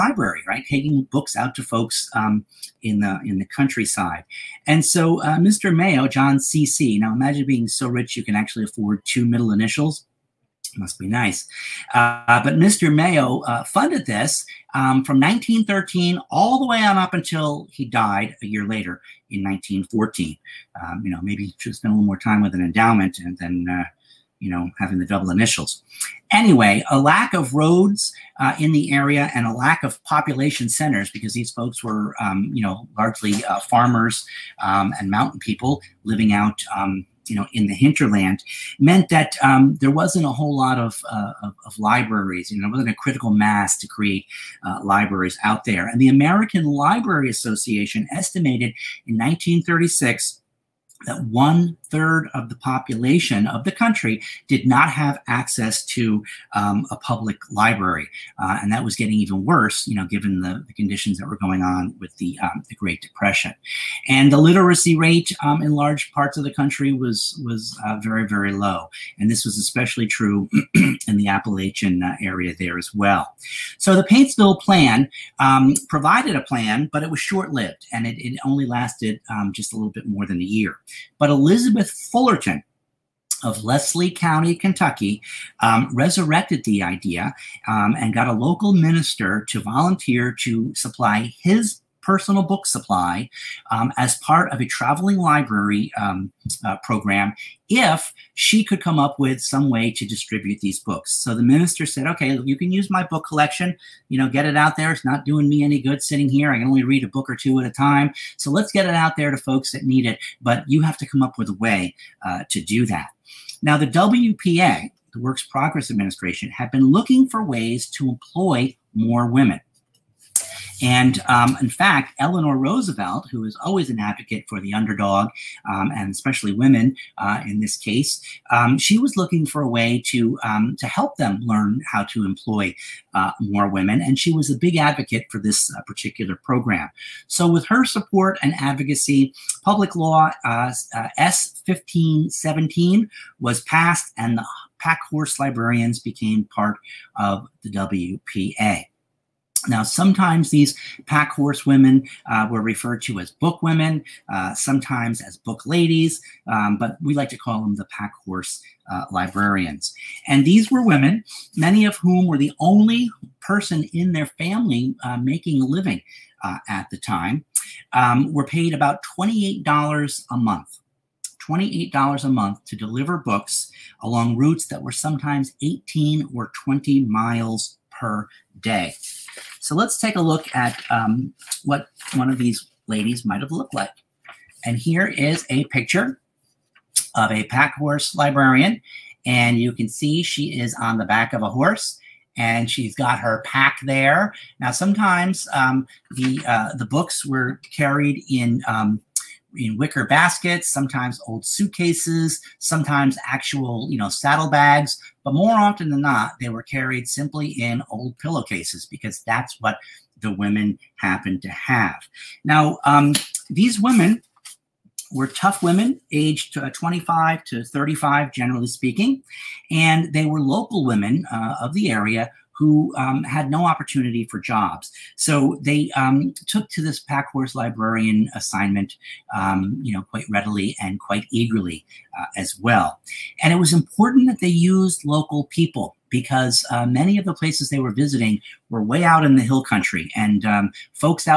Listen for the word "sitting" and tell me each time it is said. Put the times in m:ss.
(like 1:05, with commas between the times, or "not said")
1:46.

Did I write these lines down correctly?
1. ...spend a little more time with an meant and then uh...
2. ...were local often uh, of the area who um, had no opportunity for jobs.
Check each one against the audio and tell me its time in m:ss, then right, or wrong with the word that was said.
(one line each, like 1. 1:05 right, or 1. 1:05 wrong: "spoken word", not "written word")
1. 0:21 wrong: "endowment", not "meant"
2. 3:40 wrong: "women", not "often".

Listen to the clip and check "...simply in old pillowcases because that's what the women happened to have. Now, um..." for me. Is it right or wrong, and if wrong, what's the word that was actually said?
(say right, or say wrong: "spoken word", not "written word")
right.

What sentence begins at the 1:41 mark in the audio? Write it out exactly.
So the minister said, okay, you can use my book collection, you know, get it out there.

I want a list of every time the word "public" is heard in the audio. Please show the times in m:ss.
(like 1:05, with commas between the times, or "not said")
0:56, 2:19.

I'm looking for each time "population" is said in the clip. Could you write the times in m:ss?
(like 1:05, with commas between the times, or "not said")
0:30, 0:52.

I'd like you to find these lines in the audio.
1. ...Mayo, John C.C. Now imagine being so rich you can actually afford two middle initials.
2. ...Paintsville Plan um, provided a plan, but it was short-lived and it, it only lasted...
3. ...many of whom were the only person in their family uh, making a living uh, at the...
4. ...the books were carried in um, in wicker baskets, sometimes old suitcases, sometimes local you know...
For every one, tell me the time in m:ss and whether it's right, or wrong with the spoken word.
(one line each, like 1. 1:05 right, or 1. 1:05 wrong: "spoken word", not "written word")
1. 0:05 right
2. 1:14 right
3. 2:41 right
4. 3:16 wrong: "actual", not "local".